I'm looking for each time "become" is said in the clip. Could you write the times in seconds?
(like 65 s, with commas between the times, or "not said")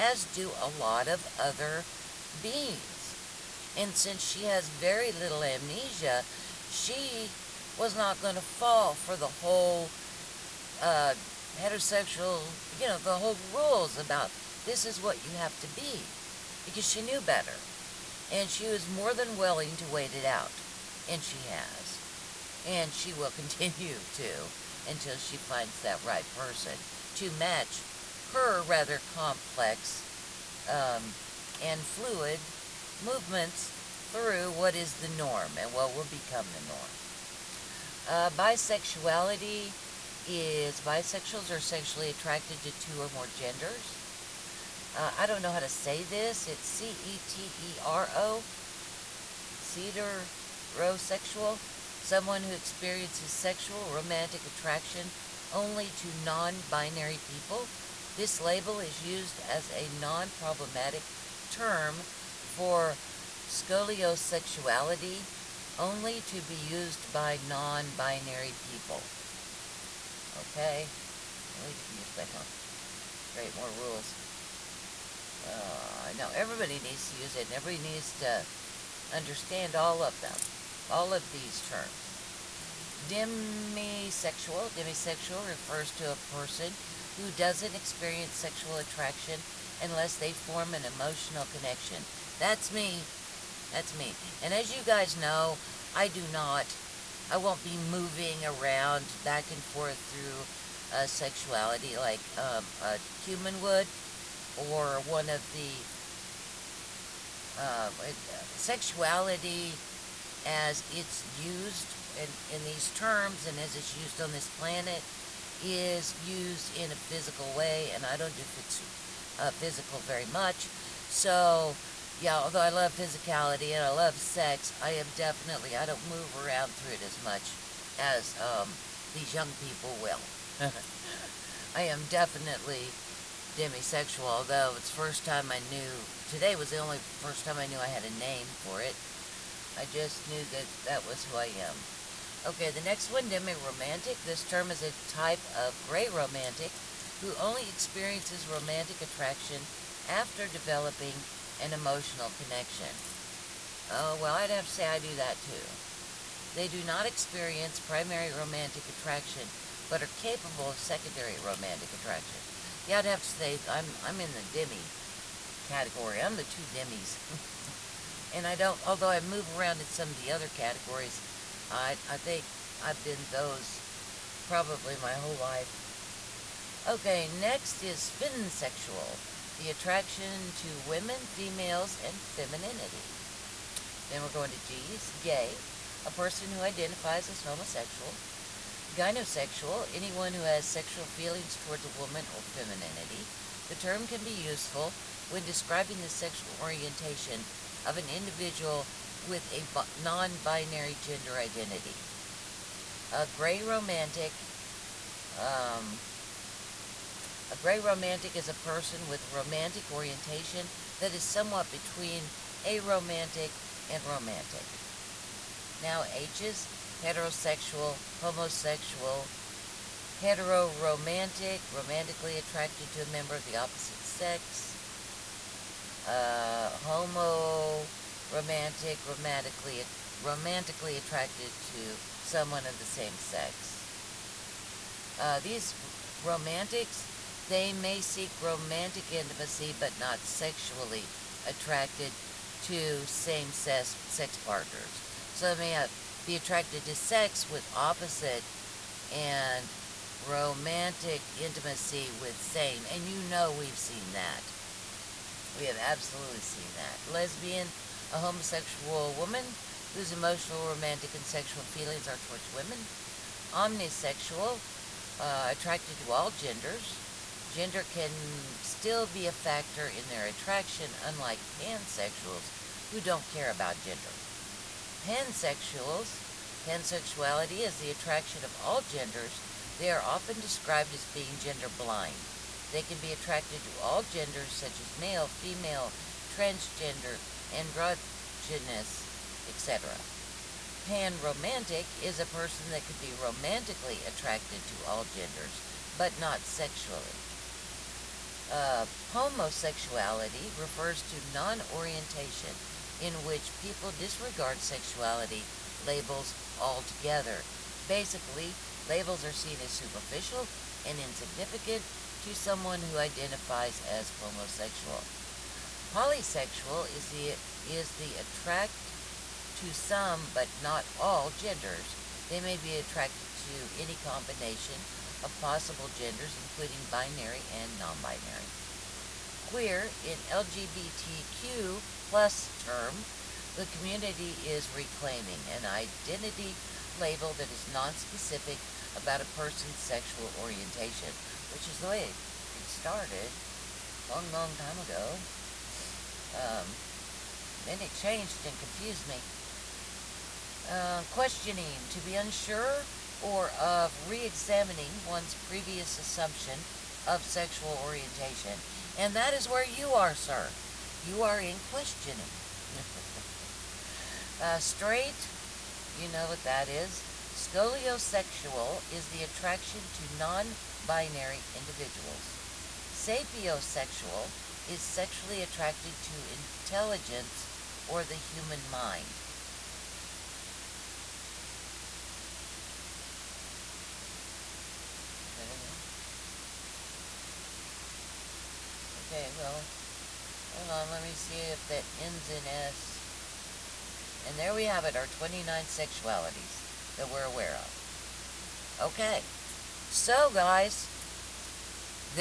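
36 s.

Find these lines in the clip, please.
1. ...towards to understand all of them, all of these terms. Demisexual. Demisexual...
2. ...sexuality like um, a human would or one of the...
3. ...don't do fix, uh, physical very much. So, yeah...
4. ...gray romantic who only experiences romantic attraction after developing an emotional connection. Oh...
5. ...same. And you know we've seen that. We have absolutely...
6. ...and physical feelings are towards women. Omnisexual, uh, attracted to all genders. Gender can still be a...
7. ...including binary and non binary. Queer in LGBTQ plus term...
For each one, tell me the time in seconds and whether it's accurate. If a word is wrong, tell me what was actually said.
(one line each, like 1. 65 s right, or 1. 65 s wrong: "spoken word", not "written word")
1. 77 s wrong: "needs", not "towards"
2. 101 s right
3. 118 s right
4. 145 s right
5. 252 s right
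6. 261 s wrong: "sexual", not "physical"
7. 326 s right.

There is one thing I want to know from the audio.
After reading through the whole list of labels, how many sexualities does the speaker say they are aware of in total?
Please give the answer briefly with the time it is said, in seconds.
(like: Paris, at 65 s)
29, at 395 s.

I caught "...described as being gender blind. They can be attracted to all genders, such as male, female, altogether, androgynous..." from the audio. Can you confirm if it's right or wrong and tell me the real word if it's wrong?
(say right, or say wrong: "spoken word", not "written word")
wrong: "transgender", not "altogether".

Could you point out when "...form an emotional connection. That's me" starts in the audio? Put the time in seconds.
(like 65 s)
90 s.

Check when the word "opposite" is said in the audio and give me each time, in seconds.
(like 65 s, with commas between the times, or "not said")
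223 s, 247 s.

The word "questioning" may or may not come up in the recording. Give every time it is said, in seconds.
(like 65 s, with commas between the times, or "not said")
351 s, 361 s.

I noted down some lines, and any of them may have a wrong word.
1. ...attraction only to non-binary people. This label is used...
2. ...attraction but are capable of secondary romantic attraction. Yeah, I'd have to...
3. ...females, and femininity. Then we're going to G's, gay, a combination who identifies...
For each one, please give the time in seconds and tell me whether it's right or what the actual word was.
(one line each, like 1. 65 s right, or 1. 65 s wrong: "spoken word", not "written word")
1. 54 s right
2. 158 s right
3. 181 s wrong: "person", not "combination".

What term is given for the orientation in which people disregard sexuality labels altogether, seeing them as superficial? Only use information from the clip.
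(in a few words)
Pomosexuality.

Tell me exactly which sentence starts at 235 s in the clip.
Uh, these romantics, they may seek romantic intimacy but not sexually attracted to same sex, sex partners.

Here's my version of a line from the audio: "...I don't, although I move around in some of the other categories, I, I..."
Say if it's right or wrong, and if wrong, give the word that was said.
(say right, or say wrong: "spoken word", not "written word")
right.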